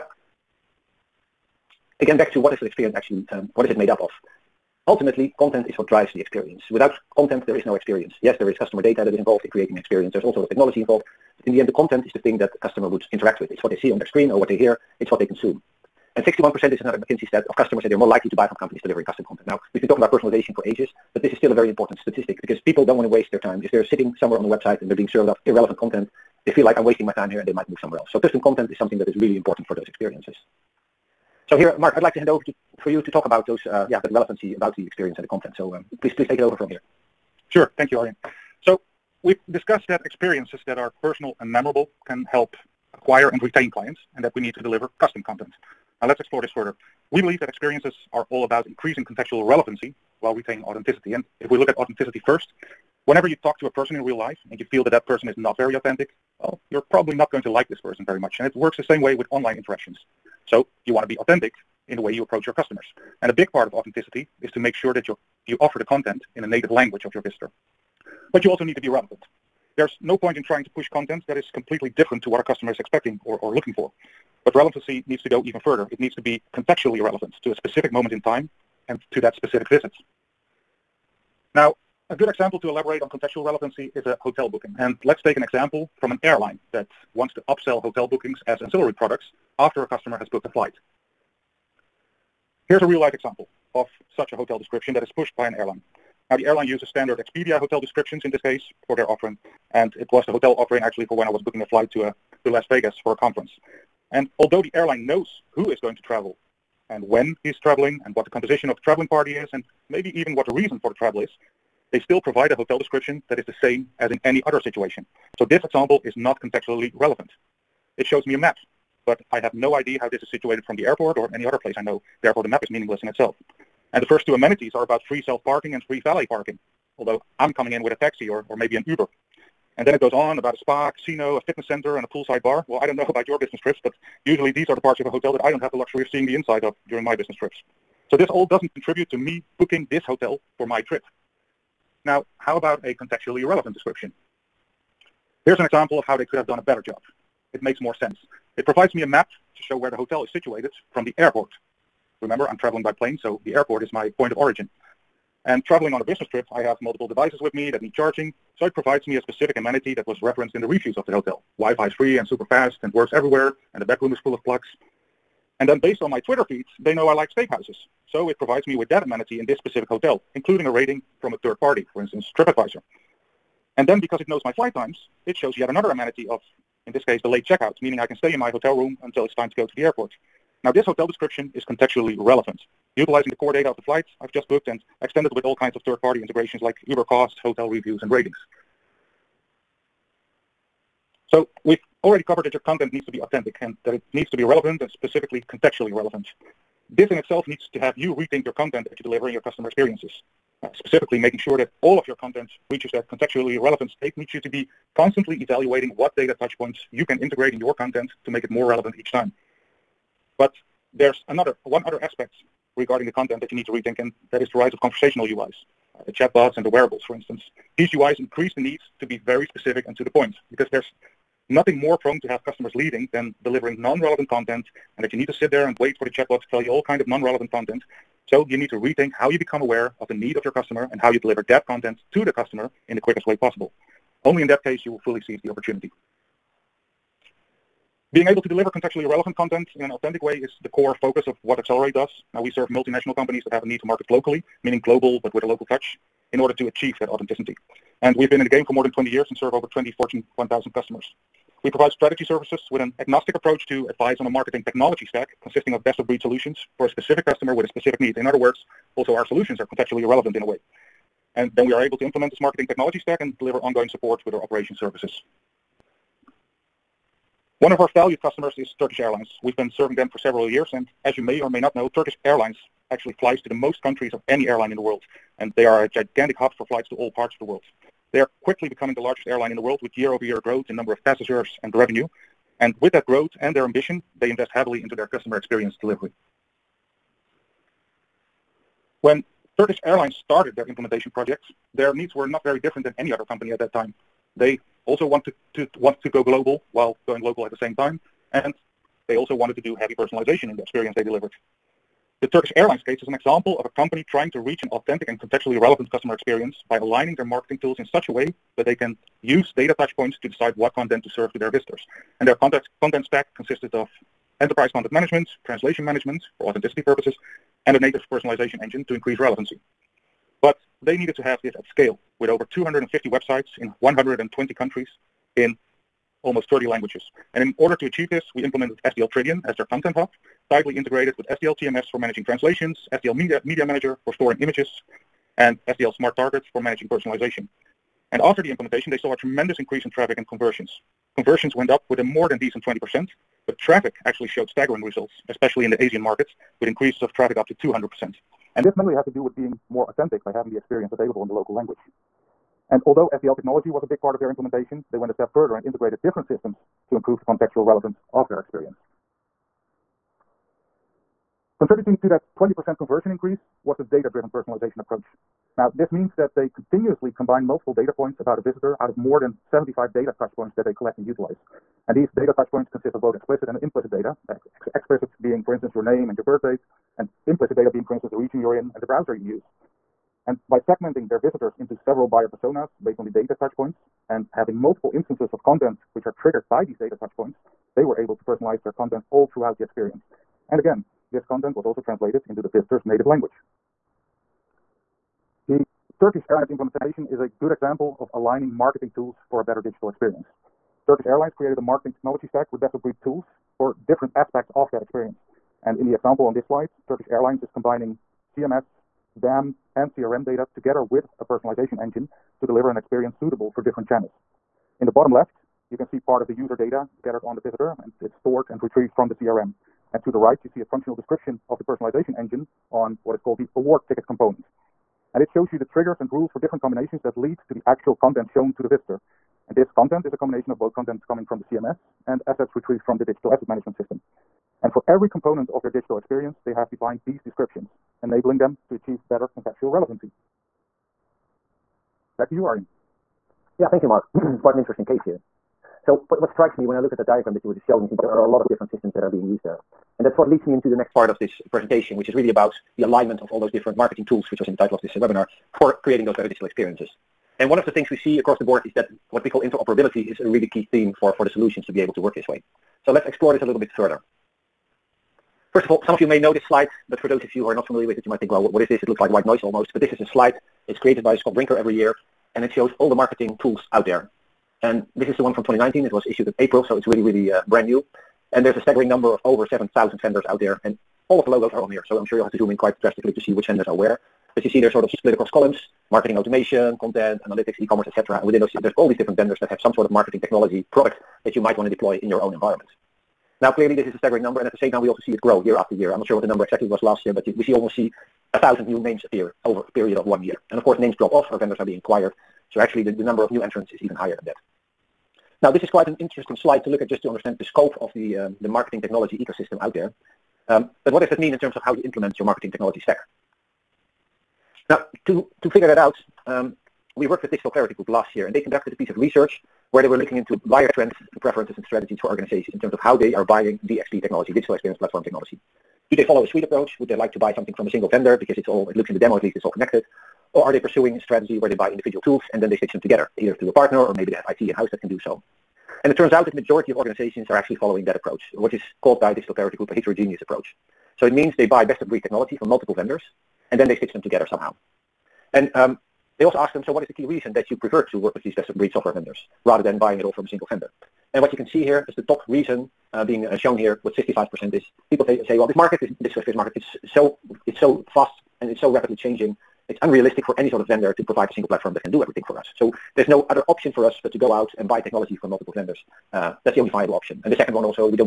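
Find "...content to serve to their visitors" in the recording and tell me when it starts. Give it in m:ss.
5:10.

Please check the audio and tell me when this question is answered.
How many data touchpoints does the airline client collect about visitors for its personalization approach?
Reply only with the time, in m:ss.
6:08.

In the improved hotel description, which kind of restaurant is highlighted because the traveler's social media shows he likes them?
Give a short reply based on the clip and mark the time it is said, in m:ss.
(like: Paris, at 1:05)
Steakhouses, at 2:47.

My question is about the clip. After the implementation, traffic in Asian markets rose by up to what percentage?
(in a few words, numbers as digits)
200%.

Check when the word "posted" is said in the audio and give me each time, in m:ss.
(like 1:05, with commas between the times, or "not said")
not said.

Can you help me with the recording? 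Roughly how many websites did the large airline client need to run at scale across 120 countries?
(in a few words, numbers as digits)
250.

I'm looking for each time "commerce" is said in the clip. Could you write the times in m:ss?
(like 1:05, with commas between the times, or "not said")
8:07.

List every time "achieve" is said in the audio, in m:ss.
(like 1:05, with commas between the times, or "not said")
4:06, 5:27, 7:18.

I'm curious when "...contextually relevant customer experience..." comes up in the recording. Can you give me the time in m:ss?
5:05.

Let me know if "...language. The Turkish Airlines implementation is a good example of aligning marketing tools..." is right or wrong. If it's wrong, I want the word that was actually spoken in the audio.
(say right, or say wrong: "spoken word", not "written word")
right.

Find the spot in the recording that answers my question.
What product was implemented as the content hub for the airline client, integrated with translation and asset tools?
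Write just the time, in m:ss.
5:28.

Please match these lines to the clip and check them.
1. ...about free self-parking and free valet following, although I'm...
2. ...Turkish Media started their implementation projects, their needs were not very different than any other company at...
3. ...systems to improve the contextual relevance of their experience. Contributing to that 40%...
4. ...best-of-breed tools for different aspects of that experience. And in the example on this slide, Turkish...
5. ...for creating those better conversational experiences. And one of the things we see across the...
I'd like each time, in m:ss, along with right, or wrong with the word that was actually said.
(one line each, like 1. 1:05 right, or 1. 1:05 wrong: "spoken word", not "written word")
1. 2:04 wrong: "parking", not "following"
2. 4:49 wrong: "Airlines", not "Media"
3. 5:56 wrong: "20", not "40"
4. 6:42 right
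5. 7:35 wrong: "digital", not "conversational".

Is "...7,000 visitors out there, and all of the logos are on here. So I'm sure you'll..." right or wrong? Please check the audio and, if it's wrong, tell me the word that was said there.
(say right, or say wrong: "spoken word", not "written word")
wrong: "vendors", not "visitors".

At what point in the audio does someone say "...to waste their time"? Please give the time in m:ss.
0:23.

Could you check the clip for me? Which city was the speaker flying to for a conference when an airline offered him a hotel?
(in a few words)
Las Vegas.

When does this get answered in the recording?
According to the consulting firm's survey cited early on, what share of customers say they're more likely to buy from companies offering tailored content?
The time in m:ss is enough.
0:16.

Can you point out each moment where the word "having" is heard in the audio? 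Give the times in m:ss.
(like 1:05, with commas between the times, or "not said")
5:50, 6:24.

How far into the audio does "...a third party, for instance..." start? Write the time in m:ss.
2:51.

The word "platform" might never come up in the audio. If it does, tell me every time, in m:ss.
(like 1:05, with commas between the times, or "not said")
8:44, 9:21.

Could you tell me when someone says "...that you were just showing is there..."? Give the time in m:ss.
7:27.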